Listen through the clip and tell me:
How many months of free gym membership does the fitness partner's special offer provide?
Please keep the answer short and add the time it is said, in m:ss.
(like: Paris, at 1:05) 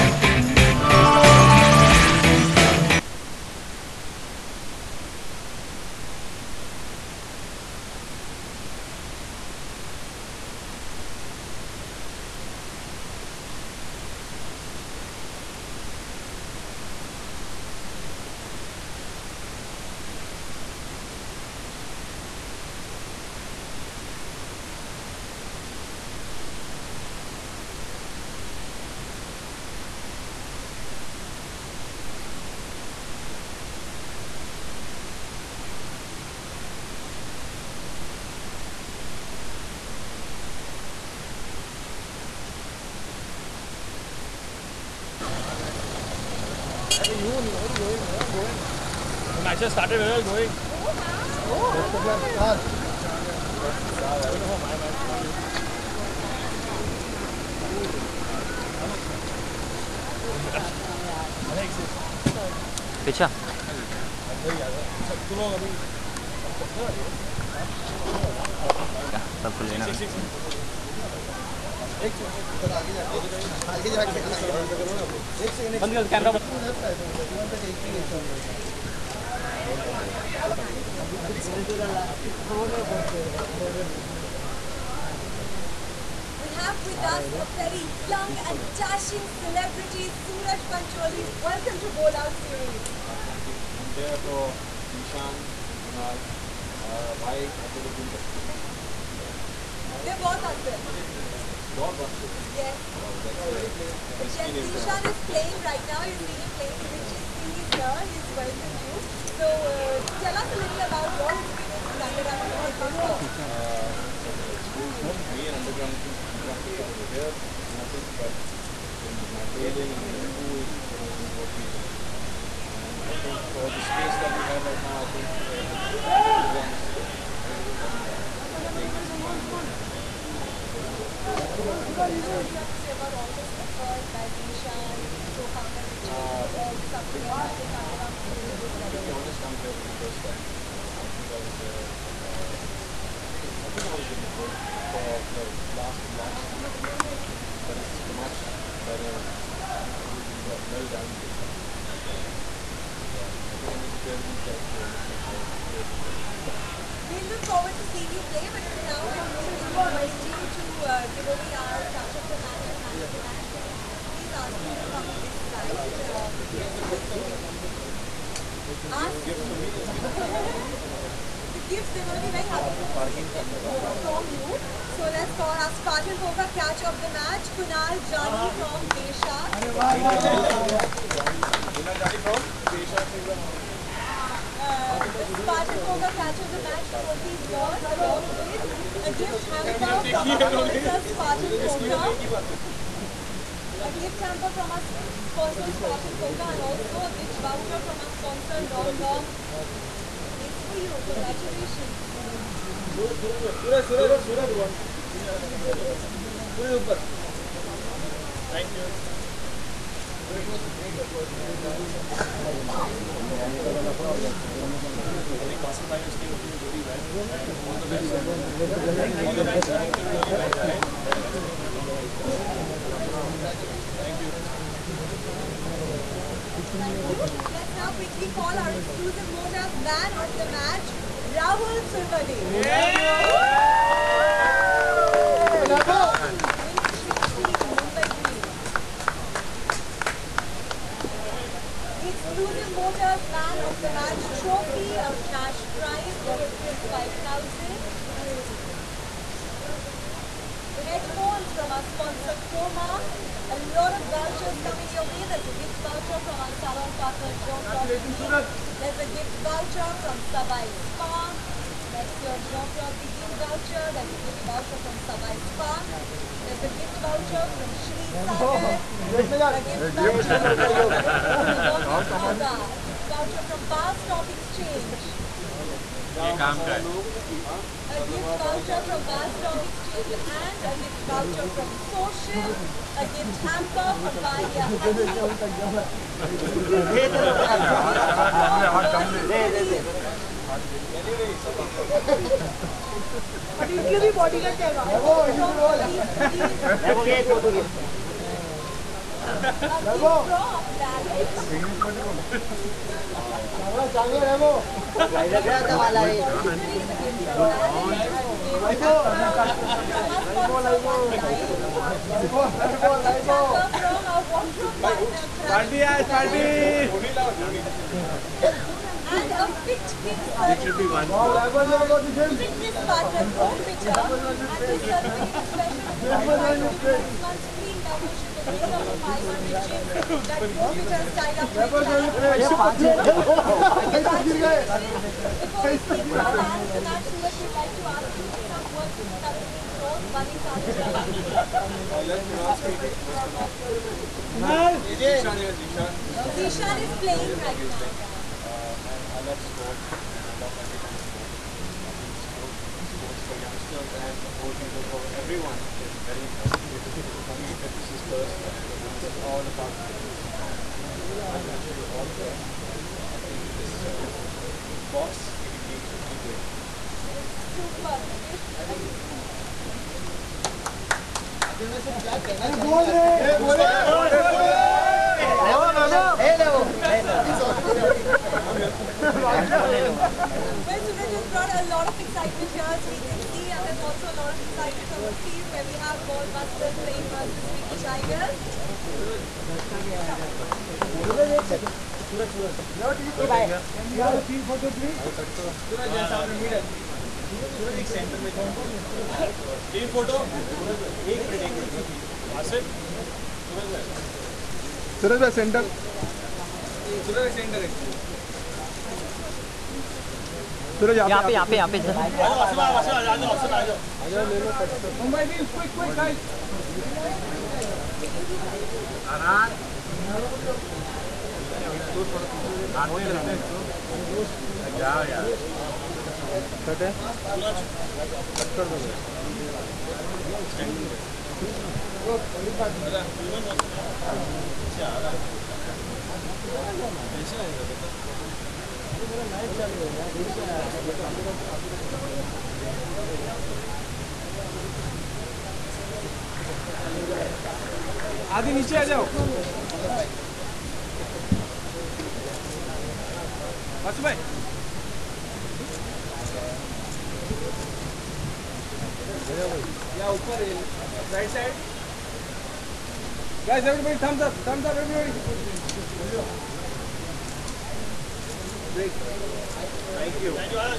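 6, at 5:27.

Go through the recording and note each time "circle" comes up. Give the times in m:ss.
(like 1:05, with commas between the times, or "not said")
5:20, 5:24.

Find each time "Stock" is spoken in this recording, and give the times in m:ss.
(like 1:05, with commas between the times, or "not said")
4:33, 4:39.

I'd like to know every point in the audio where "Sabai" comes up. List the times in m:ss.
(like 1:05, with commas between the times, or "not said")
4:20, 4:24.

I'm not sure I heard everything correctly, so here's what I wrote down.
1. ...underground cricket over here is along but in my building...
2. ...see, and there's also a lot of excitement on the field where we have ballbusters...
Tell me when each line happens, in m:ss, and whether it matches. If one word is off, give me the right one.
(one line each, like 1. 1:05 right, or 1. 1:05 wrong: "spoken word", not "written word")
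1. 1:56 wrong: "nothing", not "along"
2. 6:23 right.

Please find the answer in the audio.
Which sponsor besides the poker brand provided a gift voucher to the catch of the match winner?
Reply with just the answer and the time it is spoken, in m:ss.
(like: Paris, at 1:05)
Long Long, at 3:18.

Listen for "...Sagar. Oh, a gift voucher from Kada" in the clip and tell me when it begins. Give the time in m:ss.
4:28.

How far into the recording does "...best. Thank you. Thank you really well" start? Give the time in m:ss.
3:37.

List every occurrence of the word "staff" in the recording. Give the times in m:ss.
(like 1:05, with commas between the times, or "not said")
not said.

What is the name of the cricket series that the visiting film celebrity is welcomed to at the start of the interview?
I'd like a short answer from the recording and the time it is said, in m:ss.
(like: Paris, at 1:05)
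Bowl Out series, at 1:31.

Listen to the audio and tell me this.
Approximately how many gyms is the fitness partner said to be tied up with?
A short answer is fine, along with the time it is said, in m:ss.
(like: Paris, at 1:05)
500, at 5:28.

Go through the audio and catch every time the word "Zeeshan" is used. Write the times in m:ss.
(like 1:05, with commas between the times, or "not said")
1:34, 2:14, 5:46.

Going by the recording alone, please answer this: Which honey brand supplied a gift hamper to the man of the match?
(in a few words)
Baya Honey.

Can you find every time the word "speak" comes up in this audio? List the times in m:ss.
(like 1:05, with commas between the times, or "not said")
5:35, 5:42.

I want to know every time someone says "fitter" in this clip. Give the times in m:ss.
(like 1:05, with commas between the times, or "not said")
5:23, 5:30.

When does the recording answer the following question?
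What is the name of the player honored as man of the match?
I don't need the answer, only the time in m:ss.
3:51.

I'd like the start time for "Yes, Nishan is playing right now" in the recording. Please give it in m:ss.
1:44.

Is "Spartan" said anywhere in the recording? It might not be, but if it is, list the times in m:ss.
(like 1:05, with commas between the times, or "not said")
2:55, 3:05, 3:11, 3:15.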